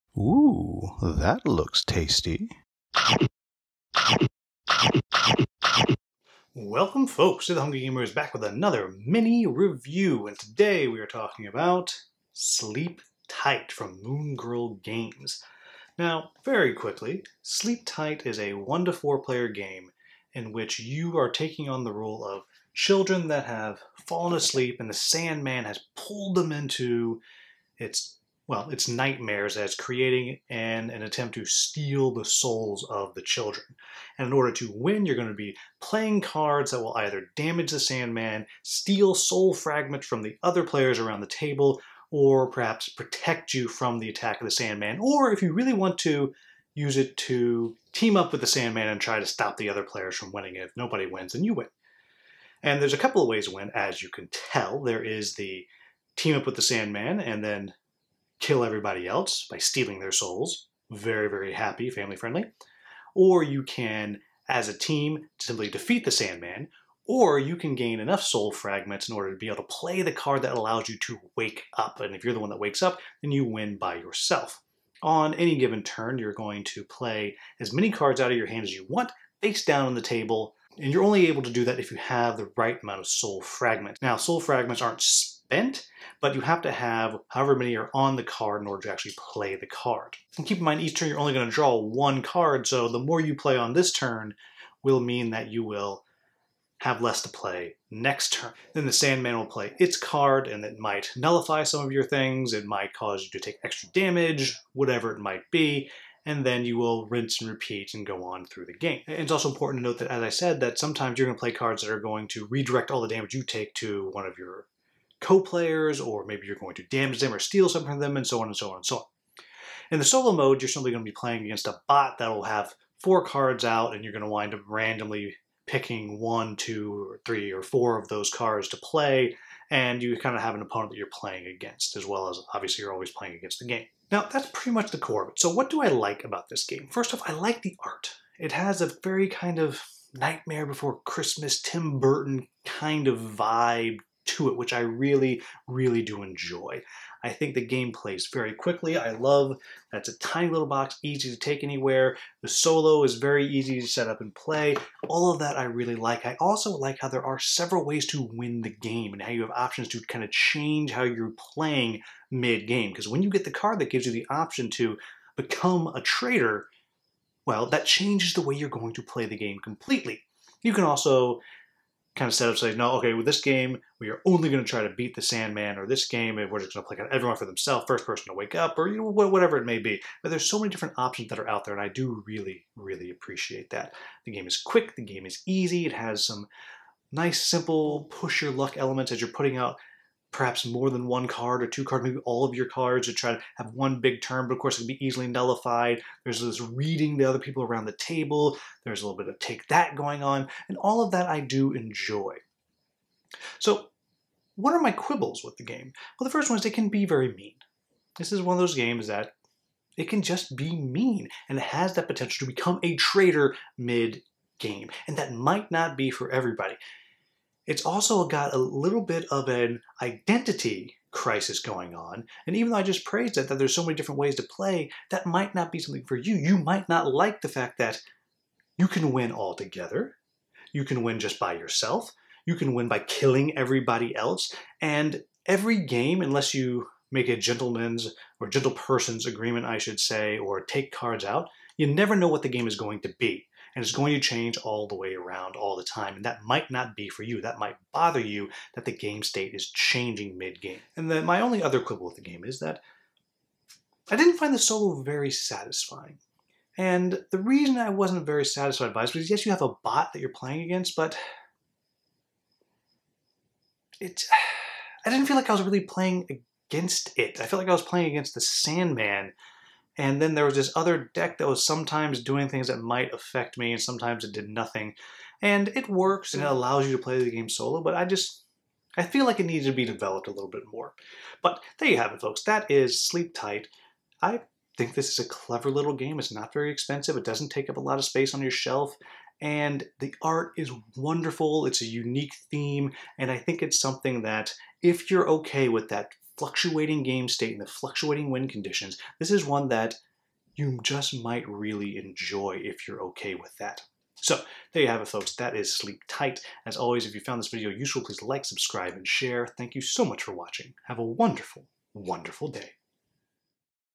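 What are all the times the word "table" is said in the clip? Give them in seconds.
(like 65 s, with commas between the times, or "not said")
41 s, 80 s, 197 s.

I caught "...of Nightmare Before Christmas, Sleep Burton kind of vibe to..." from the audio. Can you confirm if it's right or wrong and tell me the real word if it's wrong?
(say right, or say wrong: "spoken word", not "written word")
wrong: "Tim", not "Sleep".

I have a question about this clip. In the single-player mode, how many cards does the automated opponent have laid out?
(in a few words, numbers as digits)
4.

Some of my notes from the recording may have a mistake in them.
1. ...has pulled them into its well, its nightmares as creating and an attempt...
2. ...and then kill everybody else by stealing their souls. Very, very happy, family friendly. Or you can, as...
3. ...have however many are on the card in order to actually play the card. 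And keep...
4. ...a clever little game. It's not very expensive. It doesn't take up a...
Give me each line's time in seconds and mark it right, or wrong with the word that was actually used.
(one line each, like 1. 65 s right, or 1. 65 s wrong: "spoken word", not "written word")
1. 25 s right
2. 57 s right
3. 86 s right
4. 285 s right.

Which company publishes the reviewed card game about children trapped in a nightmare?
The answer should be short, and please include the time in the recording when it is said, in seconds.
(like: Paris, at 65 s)
Moongrel Games, at 14 s.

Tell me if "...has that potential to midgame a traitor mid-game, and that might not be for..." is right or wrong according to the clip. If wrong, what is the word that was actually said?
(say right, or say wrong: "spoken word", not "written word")
wrong: "become", not "midgame".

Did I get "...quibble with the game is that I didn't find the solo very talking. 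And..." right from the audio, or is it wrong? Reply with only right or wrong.
wrong.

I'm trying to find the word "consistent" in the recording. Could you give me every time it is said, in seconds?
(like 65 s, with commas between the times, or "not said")
not said.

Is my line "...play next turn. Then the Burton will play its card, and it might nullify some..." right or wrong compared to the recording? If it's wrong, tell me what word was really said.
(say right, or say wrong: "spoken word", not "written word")
wrong: "Sandman", not "Burton".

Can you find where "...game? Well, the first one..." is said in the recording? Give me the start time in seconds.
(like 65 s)
205 s.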